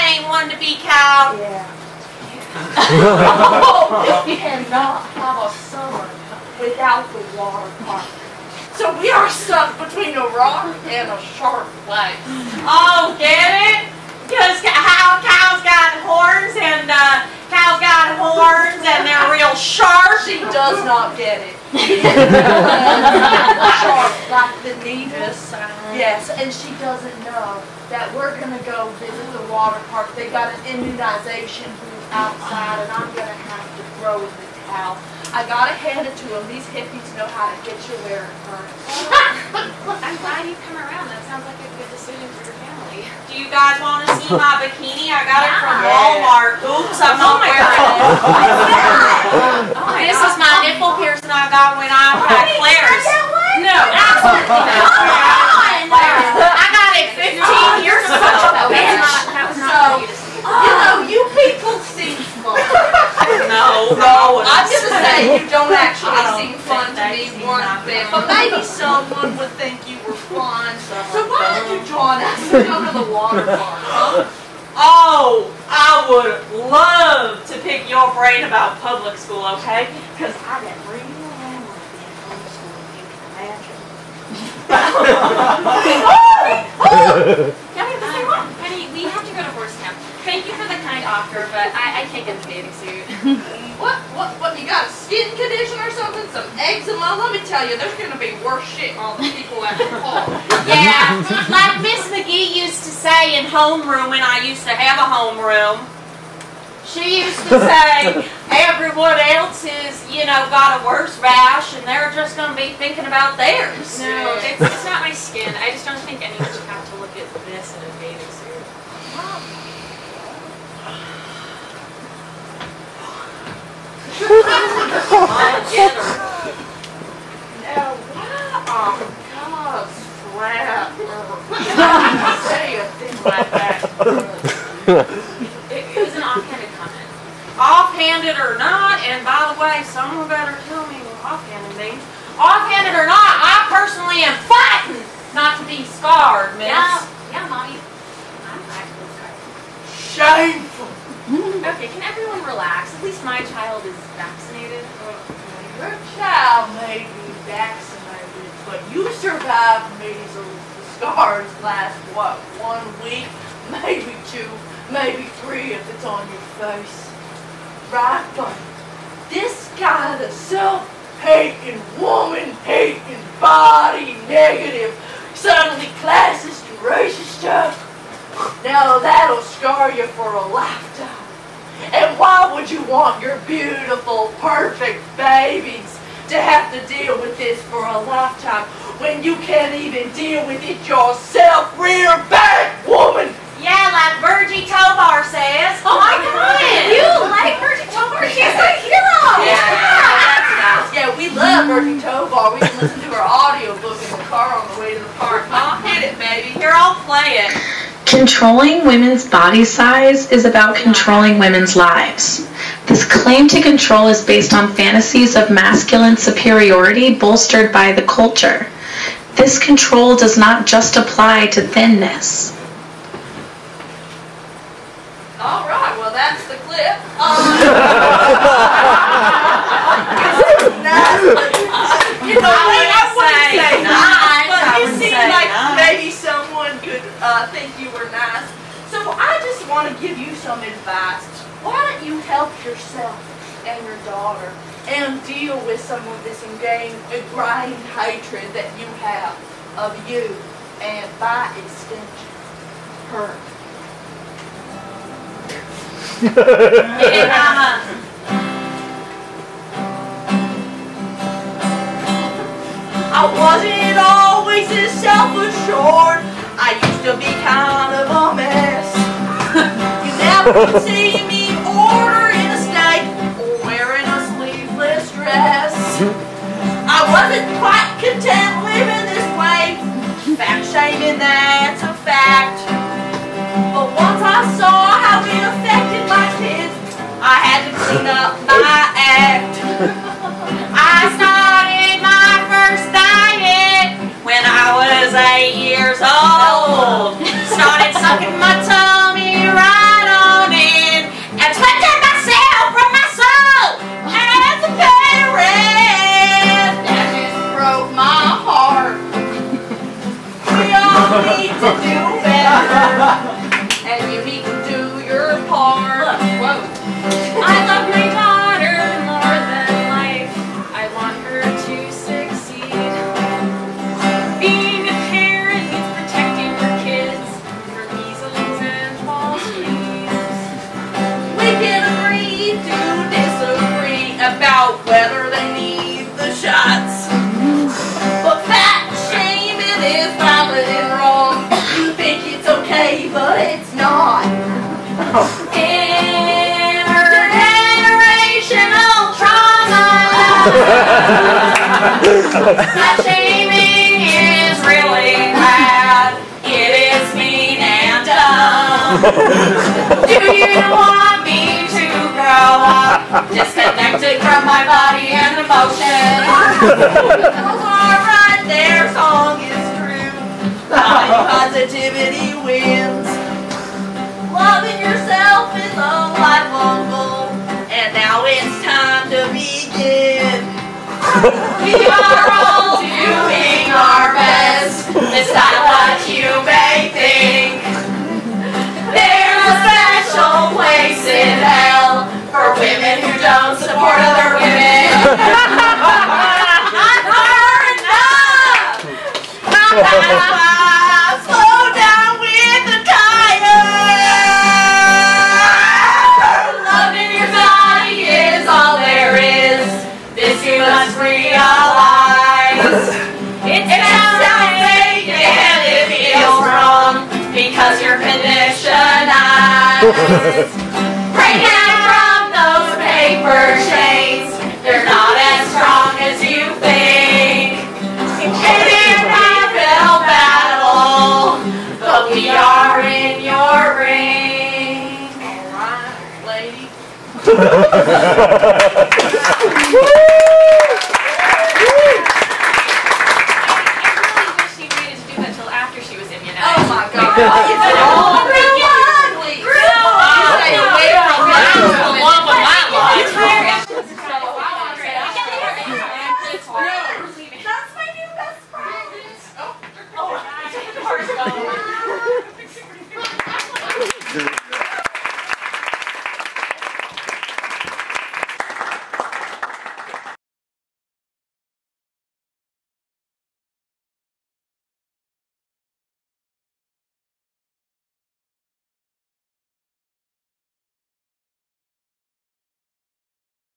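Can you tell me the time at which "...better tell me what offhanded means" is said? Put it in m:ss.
2:20.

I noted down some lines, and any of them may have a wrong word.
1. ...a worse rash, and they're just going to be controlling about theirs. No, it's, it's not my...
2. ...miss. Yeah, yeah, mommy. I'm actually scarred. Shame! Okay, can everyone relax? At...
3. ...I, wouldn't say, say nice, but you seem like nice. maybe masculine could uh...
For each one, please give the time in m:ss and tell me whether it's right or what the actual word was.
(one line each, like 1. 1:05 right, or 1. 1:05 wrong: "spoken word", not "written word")
1. 1:50 wrong: "thinking", not "controlling"
2. 2:26 right
3. 3:52 wrong: "someone", not "masculine".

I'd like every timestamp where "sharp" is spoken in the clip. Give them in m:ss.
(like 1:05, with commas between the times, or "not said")
0:11, 0:19, 0:23.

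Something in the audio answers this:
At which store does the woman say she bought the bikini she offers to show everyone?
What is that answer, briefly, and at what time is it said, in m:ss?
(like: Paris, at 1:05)
Walmart, at 0:45.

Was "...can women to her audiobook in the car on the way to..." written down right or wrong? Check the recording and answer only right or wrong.
wrong.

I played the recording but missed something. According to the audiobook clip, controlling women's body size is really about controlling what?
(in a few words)
women's lives.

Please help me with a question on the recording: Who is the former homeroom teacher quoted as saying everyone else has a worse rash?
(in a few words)
Miss McGee.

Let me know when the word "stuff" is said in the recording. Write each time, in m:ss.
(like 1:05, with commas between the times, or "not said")
2:57.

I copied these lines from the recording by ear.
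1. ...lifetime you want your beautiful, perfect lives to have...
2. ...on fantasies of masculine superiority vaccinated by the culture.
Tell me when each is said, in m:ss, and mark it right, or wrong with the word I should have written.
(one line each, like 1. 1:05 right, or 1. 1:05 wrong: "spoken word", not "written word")
1. 3:00 wrong: "babies", not "lives"
2. 3:34 wrong: "bolstered", not "vaccinated".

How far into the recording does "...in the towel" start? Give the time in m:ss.
0:34.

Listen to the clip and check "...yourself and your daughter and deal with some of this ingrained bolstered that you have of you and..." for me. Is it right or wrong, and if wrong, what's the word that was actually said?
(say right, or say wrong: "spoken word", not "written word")
wrong: "hatred", not "bolstered".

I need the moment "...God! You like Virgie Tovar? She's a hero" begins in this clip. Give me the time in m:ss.
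3:16.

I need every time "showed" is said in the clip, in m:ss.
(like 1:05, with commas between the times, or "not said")
not said.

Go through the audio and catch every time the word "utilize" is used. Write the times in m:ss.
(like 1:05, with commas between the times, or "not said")
not said.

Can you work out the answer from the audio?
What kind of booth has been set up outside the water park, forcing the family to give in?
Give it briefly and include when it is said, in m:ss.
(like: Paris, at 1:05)
immunization booth, at 0:30.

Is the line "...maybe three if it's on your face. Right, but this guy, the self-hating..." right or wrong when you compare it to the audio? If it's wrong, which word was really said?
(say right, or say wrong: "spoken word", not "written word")
right.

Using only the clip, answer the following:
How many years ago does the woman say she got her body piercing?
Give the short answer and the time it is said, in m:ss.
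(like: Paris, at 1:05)
15, at 0:57.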